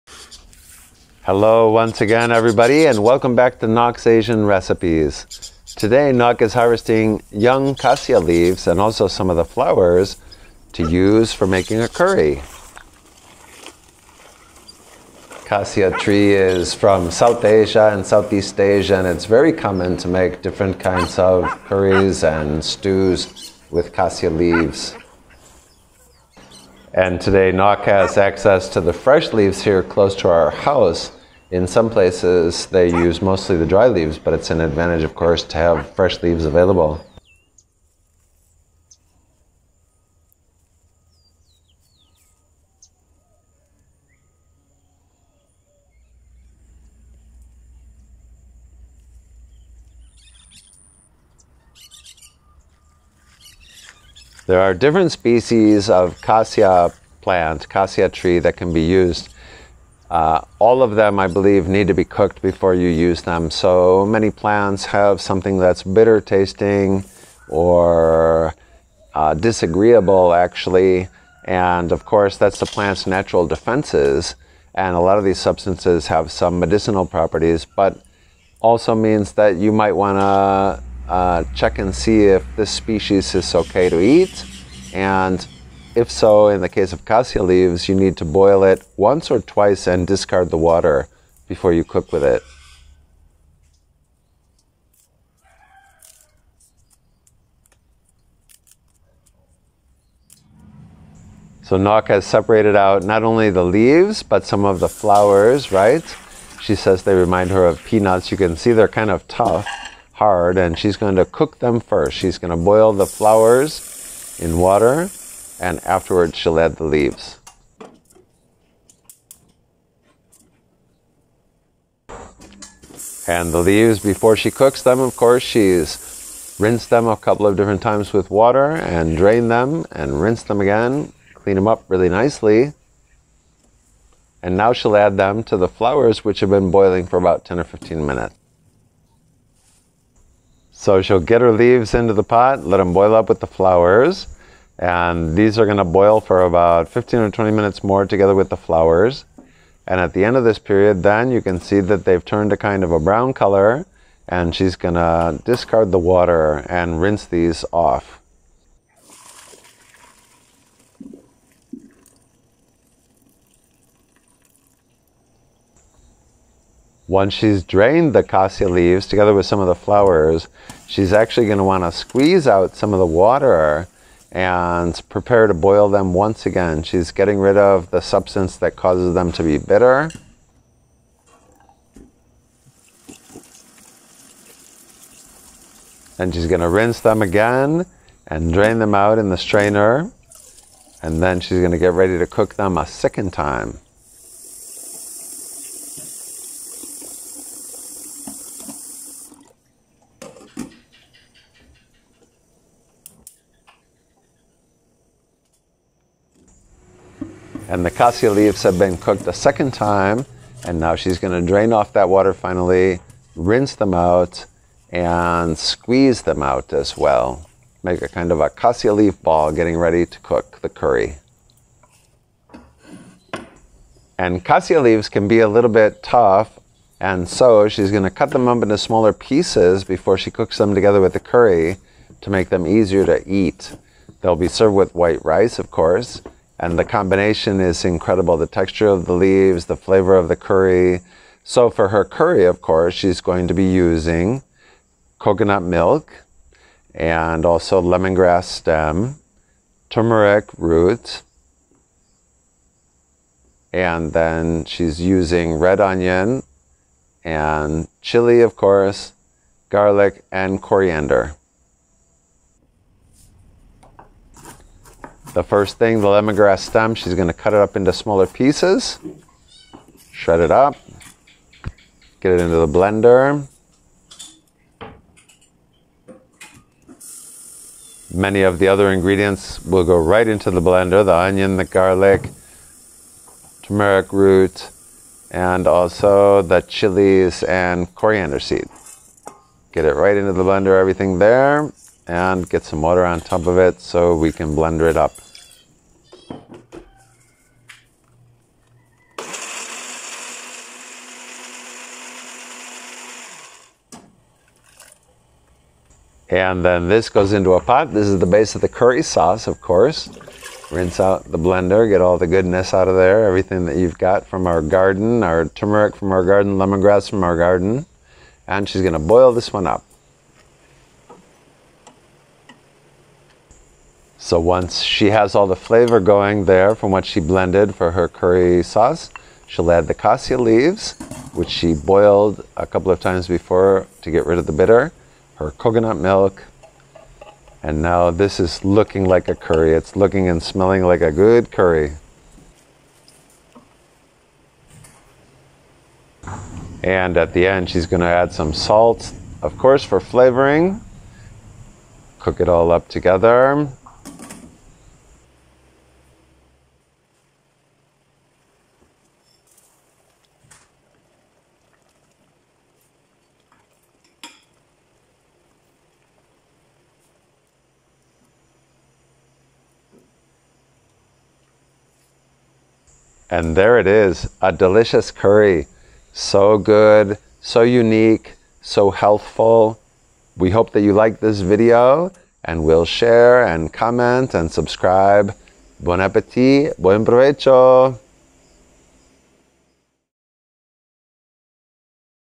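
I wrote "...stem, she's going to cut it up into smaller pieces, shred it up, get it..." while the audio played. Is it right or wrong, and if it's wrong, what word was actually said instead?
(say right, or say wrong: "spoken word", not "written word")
right.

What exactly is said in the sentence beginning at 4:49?
Get it right into the blender, everything there and get some water on top of it so we can blender it up.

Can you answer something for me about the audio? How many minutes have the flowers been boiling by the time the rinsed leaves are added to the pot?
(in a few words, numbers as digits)
10 or 15 minutes.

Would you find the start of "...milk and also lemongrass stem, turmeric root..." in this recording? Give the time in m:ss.
4:05.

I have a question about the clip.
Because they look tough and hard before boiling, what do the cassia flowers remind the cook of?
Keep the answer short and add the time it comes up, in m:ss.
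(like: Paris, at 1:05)
Peanuts, at 1:47.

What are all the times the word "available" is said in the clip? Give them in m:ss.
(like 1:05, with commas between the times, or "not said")
0:36.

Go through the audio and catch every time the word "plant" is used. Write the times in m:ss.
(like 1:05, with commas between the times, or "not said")
0:57, 1:04, 1:12.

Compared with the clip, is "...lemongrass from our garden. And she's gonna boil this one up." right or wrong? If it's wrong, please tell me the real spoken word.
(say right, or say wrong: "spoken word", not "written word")
right.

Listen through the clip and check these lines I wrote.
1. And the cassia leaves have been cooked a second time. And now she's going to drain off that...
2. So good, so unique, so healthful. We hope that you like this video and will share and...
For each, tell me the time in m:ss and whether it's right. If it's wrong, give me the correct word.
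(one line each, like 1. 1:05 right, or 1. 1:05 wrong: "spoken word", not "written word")
1. 3:27 right
2. 6:16 right.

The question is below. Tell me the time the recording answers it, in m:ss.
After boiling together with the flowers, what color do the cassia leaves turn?
2:32.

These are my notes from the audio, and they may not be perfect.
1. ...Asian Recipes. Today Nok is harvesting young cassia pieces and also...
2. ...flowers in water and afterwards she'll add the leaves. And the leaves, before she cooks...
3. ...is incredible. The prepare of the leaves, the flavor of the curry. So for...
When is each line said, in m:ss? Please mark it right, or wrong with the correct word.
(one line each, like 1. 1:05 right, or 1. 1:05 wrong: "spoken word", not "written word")
1. 0:04 wrong: "leaves", not "pieces"
2. 1:53 right
3. 3:57 wrong: "texture", not "prepare".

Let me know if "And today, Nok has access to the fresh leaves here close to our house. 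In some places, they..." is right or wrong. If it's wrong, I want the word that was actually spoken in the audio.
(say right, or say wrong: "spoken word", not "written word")
right.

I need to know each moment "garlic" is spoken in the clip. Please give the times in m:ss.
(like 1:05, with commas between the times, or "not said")
4:19, 4:41.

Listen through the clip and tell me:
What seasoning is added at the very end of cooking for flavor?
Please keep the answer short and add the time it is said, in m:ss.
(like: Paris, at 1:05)
Salt, at 5:48.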